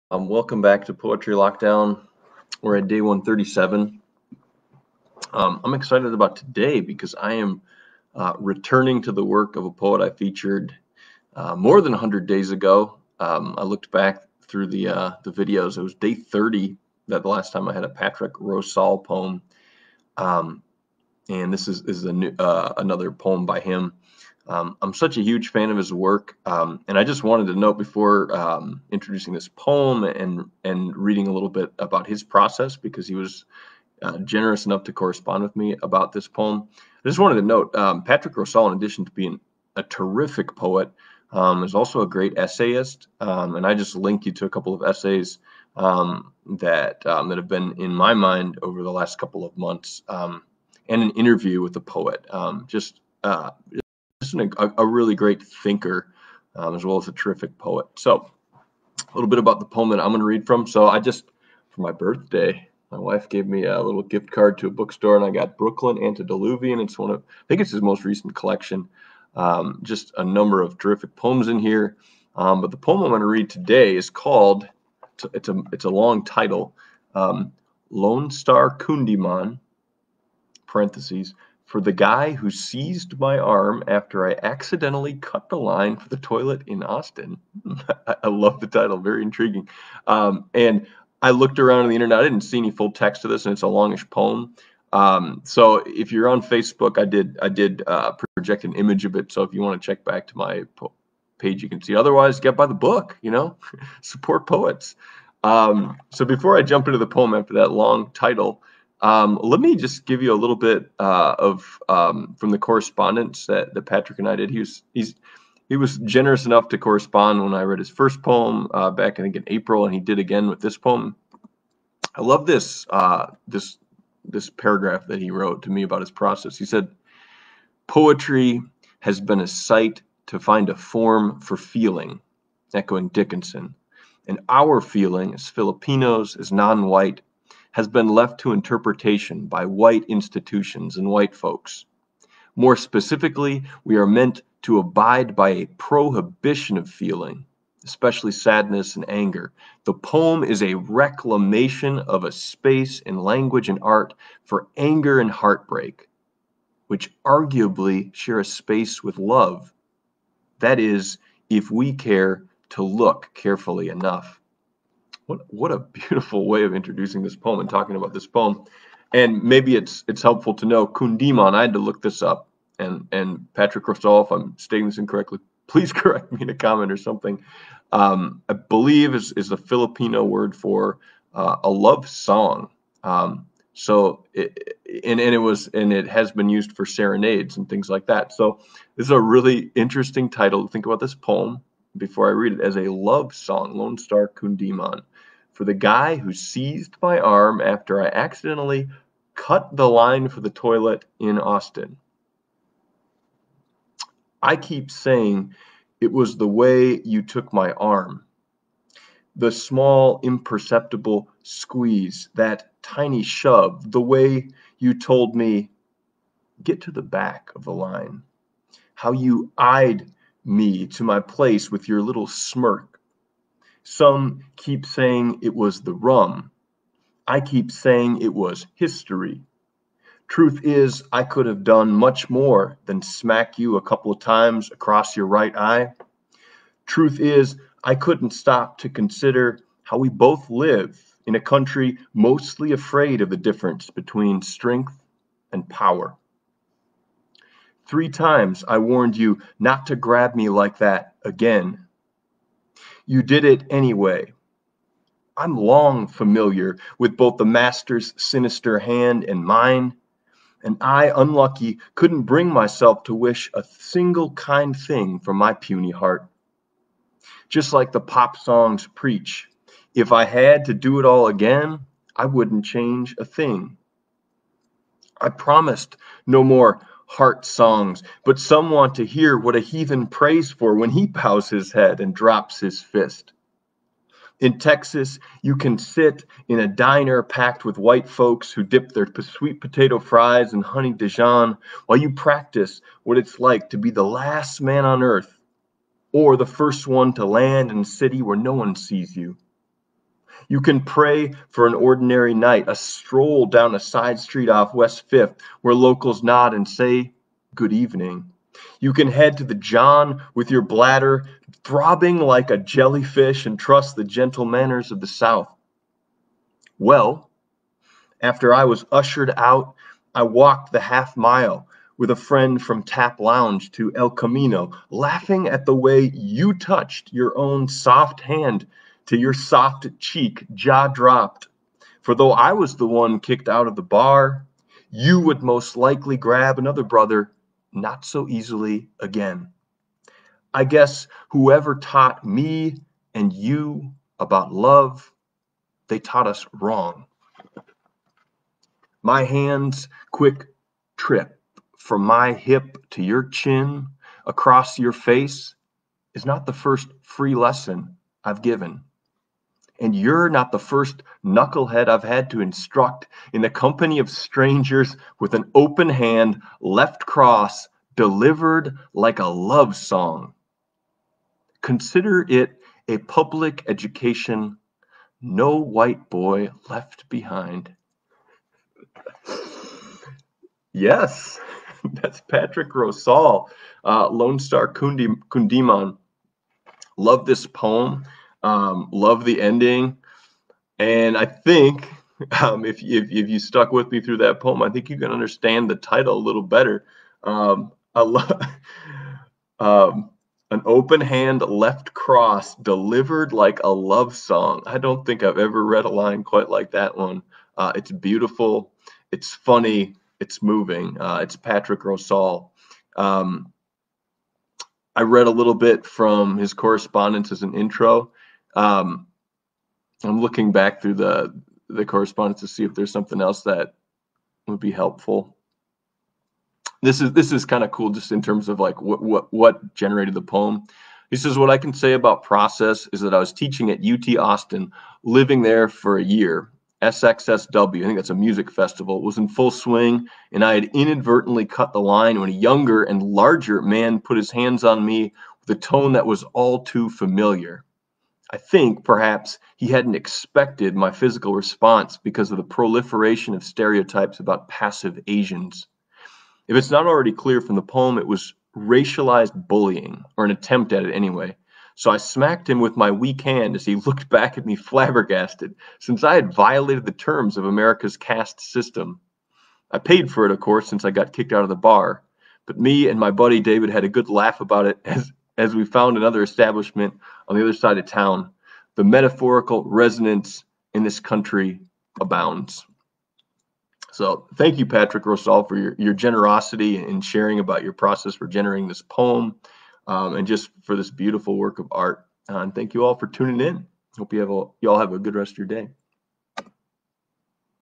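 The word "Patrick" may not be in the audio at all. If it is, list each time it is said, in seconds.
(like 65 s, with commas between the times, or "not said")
17 s, 38 s, 113 s, 173 s, 382 s, 411 s, 484 s.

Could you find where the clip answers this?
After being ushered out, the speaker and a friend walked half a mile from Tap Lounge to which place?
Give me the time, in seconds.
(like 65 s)
323 s.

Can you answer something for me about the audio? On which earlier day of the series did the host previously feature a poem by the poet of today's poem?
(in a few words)
Day 30.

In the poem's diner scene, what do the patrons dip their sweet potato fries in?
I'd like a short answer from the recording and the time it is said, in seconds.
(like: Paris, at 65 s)
Honey Dijon, at 290 s.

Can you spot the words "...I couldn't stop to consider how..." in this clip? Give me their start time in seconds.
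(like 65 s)
237 s.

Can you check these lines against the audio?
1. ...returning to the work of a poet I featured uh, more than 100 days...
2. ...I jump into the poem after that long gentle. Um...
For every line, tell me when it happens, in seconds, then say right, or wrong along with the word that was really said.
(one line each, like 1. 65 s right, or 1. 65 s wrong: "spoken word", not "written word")
1. 8 s right
2. 106 s wrong: "title", not "gentle".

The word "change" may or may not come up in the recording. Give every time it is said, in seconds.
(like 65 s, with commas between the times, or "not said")
272 s.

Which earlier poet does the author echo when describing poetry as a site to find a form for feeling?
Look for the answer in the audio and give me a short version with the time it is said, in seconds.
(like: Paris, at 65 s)
Dickinson, at 133 s.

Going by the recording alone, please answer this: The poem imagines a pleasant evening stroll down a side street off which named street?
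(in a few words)
West Fifth.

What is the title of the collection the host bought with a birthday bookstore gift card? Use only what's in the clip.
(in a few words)
Brooklyn Antediluvian.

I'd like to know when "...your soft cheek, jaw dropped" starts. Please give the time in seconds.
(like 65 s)
329 s.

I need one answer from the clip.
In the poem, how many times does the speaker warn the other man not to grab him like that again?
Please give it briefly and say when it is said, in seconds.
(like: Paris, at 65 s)
3, at 247 s.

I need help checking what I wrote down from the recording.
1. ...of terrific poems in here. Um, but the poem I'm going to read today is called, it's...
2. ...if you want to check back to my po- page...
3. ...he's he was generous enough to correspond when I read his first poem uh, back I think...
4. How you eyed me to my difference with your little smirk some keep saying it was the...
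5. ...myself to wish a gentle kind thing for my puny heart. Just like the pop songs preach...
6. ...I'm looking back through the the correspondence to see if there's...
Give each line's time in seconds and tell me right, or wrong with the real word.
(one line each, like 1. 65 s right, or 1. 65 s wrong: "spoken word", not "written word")
1. 70 s right
2. 99 s right
3. 114 s right
4. 218 s wrong: "place", not "difference"
5. 262 s wrong: "single", not "gentle"
6. 420 s right.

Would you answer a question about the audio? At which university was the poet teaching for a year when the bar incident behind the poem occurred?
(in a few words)
UT Austin.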